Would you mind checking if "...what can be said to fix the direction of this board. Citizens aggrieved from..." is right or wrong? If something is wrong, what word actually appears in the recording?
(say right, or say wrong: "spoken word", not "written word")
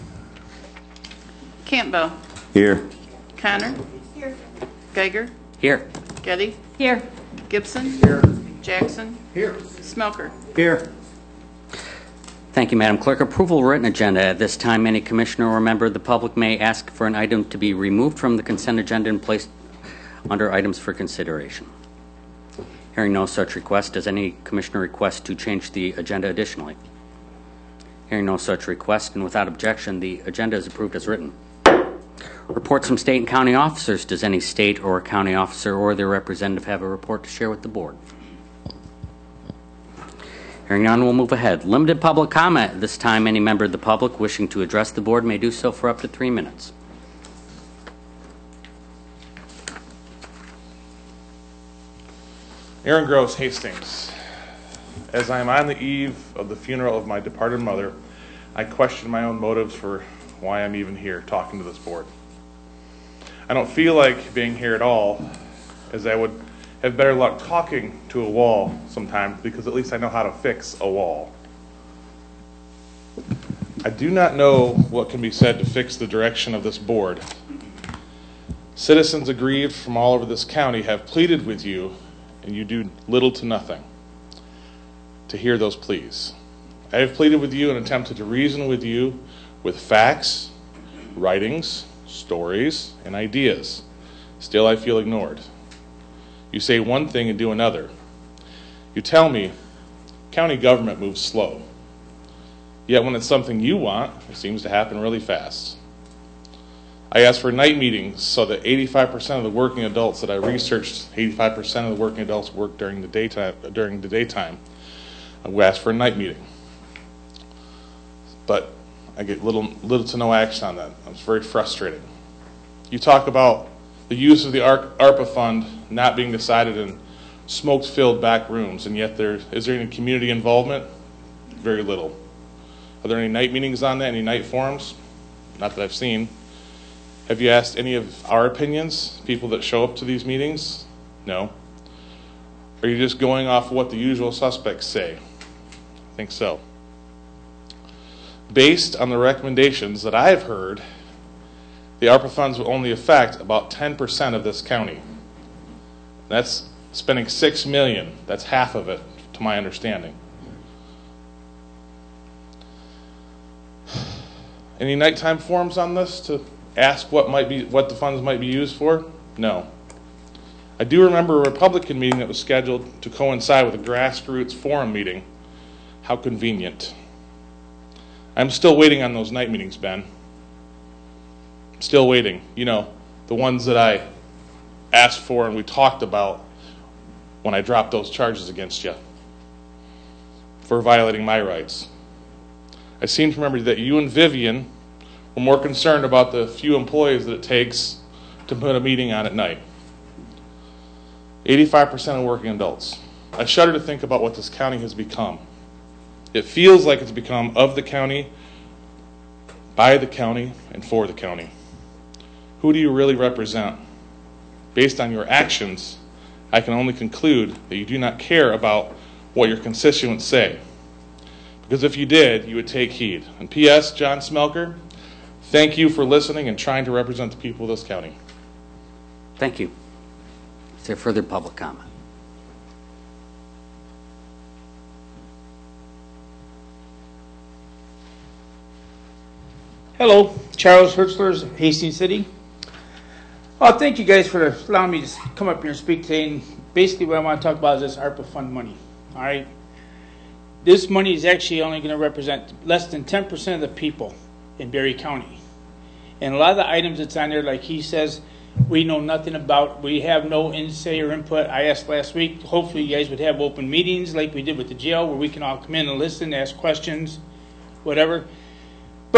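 right.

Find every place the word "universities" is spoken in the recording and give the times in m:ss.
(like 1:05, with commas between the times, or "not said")
not said.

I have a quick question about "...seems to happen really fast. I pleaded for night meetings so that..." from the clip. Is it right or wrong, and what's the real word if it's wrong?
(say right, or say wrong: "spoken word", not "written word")
wrong: "asked", not "pleaded".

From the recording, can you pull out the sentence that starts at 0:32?
Reports from state and county officers.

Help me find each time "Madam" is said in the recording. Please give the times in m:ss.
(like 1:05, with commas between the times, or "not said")
0:12.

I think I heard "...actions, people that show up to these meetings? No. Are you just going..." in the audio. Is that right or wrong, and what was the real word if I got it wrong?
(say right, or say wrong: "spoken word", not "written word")
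wrong: "opinions", not "actions".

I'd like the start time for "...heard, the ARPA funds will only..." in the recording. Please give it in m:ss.
2:30.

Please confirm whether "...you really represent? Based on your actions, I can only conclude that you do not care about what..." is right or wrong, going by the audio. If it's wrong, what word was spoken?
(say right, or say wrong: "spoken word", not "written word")
right.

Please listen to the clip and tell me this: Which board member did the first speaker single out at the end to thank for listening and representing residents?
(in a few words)
John Smelker.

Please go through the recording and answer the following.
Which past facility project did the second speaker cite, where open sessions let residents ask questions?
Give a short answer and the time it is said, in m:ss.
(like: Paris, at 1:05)
the jail, at 4:24.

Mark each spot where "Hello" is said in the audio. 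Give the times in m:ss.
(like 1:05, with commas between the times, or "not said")
3:59.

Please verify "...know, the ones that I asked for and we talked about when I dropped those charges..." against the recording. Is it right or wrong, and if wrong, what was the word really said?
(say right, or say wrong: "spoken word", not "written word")
right.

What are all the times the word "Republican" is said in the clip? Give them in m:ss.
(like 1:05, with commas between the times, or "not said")
2:51.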